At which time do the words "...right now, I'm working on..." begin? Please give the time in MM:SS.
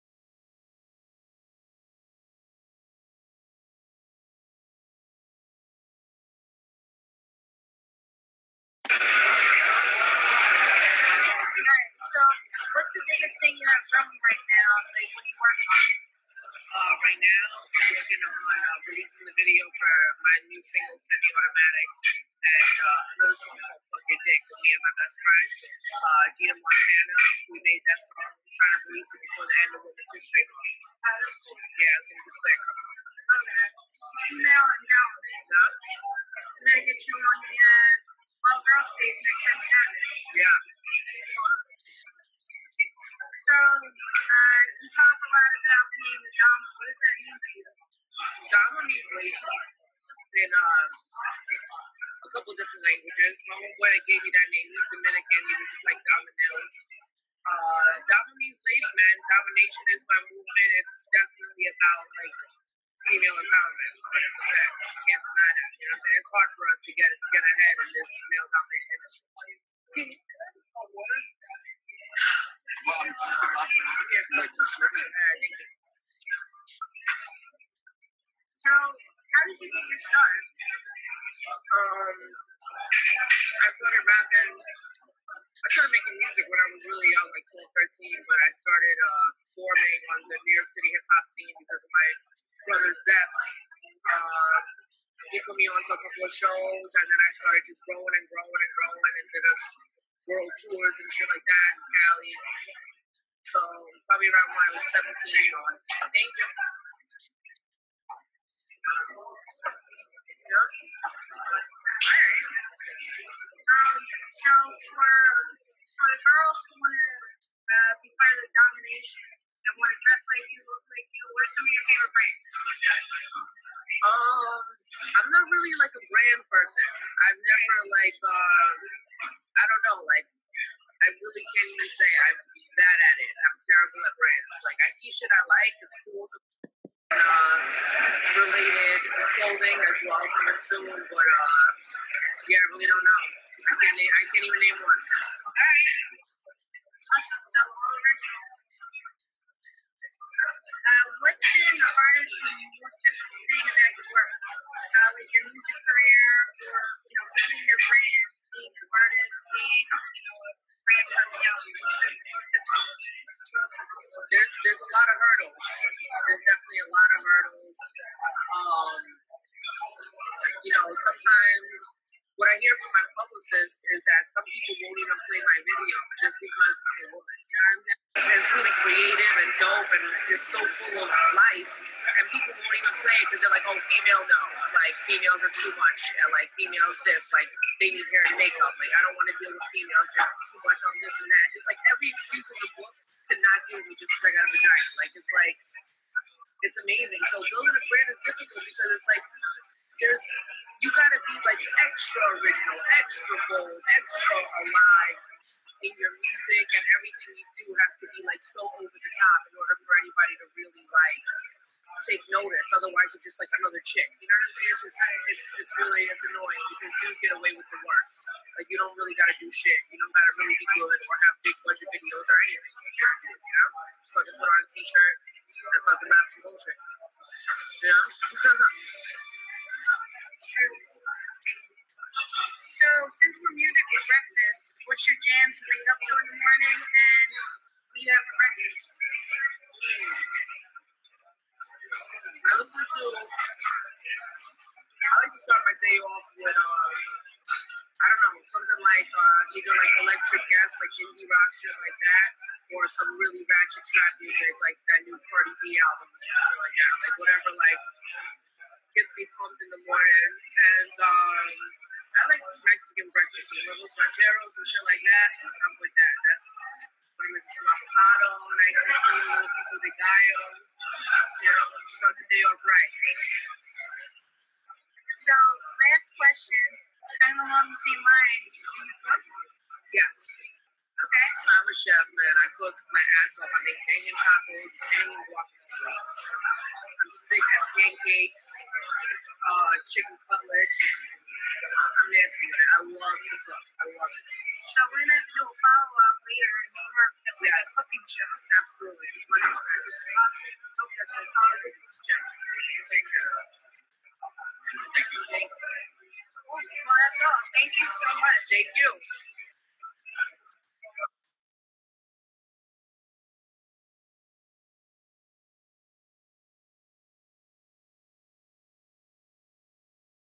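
00:17.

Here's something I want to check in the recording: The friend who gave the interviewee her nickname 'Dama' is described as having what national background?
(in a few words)
Dominican.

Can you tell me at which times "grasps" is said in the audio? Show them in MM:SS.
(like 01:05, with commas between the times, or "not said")
not said.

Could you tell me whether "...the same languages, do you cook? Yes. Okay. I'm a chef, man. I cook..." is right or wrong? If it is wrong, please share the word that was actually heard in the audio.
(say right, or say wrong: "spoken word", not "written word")
wrong: "lines", not "languages".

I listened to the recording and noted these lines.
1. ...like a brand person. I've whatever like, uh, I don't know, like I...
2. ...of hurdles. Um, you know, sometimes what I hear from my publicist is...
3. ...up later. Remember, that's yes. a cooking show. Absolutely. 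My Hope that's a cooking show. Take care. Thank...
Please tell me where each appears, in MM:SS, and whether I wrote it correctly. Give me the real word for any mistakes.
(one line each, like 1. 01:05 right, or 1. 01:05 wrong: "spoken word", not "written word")
1. 02:05 wrong: "never", not "whatever"
2. 02:47 right
3. 04:55 right.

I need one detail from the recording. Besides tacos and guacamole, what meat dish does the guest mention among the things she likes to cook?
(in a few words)
Chicken cutlets.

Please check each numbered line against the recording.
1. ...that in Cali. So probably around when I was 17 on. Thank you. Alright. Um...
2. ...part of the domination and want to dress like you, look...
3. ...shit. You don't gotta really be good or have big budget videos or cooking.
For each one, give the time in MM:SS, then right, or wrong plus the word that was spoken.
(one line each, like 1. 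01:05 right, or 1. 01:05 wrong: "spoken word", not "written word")
1. 01:41 right
2. 01:58 right
3. 03:39 wrong: "anything", not "cooking".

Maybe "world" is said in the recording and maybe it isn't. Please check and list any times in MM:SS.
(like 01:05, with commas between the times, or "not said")
01:40.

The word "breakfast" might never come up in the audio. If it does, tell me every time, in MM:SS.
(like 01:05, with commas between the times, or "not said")
03:54, 03:58, 04:23.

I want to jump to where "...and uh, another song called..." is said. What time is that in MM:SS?
00:22.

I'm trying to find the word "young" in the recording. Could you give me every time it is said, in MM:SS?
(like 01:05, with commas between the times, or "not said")
01:27.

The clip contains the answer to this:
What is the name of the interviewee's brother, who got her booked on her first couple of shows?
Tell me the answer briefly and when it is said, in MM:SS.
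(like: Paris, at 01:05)
Zeps, at 01:32.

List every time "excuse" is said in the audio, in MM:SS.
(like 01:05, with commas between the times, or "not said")
03:12.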